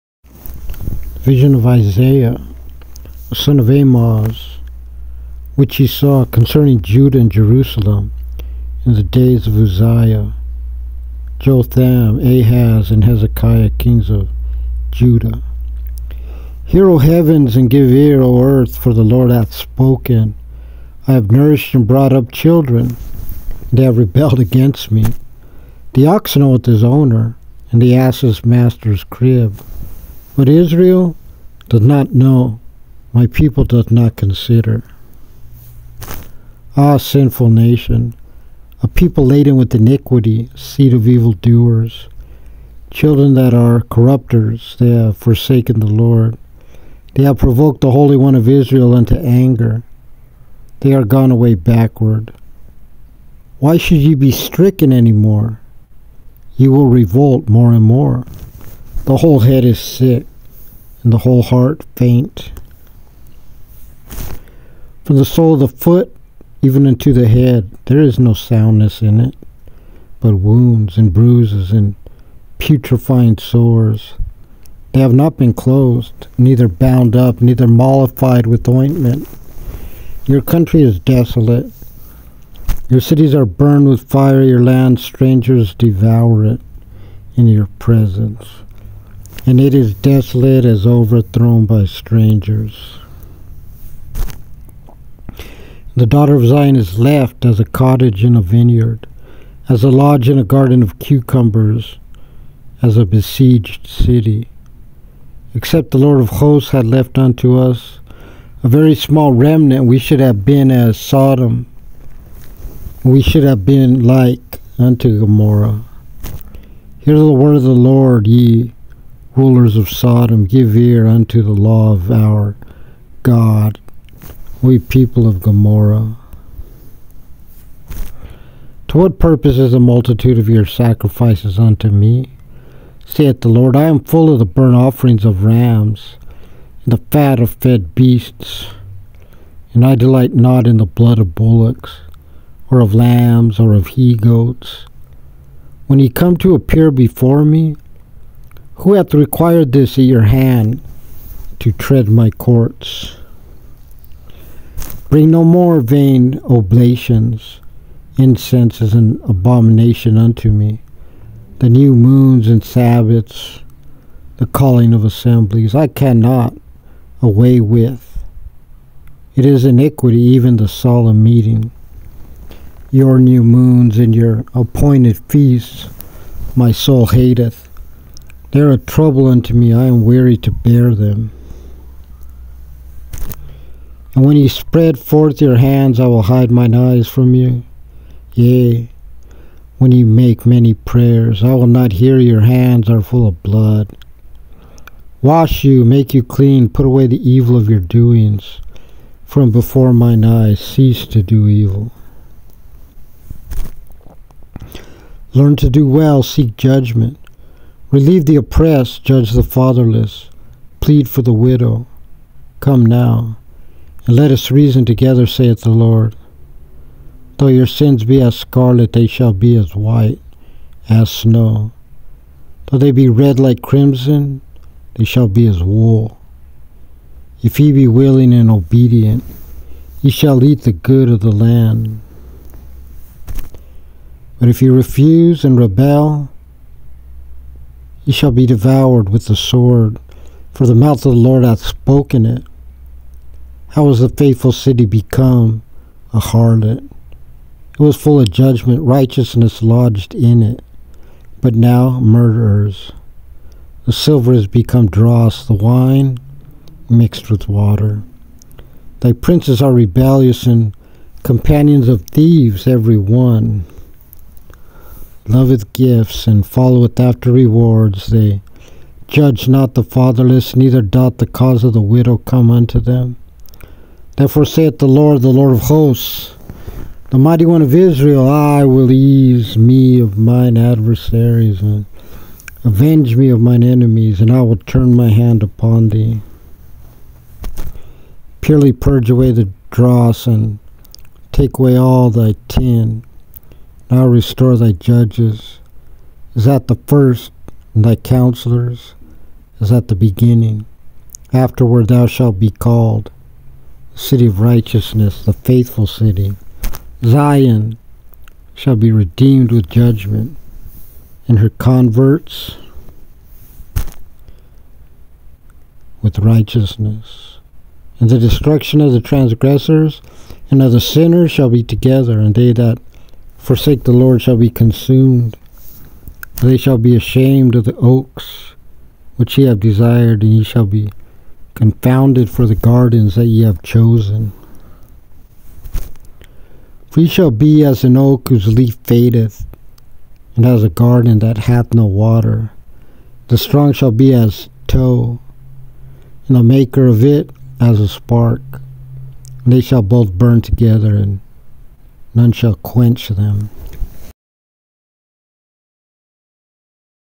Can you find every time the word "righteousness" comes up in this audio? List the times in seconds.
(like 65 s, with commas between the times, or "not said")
248 s, 304 s, 316 s.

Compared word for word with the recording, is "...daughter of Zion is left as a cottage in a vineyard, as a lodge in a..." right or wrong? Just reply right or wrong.
right.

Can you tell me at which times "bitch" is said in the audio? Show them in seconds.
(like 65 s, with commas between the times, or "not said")
not said.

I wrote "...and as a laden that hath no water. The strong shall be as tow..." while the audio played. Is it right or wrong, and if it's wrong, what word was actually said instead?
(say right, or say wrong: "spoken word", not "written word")
wrong: "garden", not "laden".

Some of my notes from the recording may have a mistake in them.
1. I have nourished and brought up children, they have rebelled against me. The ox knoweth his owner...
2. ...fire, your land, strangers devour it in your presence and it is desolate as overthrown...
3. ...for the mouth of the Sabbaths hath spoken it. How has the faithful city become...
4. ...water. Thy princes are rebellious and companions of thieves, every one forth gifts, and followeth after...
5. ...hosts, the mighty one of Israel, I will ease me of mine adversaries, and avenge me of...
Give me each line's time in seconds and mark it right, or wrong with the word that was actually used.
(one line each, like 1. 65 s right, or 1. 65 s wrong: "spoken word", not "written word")
1. 21 s right
2. 84 s right
3. 240 s wrong: "Lord", not "Sabbaths"
4. 257 s wrong: "loveth", not "forth"
5. 275 s right.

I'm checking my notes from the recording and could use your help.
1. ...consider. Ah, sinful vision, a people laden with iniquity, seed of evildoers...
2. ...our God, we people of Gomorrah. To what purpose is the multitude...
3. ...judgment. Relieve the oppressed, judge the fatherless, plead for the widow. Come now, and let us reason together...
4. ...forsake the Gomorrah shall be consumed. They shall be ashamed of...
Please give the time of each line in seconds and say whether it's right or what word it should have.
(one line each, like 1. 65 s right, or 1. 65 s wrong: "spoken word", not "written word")
1. 34 s wrong: "nation", not "vision"
2. 122 s right
3. 206 s right
4. 323 s wrong: "Lord", not "Gomorrah".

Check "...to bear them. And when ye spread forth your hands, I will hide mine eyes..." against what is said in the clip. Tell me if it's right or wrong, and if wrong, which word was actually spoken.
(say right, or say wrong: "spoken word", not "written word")
right.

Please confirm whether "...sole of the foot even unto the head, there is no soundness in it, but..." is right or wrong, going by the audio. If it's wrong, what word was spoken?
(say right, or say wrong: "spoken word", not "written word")
right.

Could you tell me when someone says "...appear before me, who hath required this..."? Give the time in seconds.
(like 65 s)
146 s.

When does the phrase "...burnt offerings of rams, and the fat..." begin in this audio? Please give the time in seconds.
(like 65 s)
134 s.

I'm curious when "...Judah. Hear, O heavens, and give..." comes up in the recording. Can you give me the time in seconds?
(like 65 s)
14 s.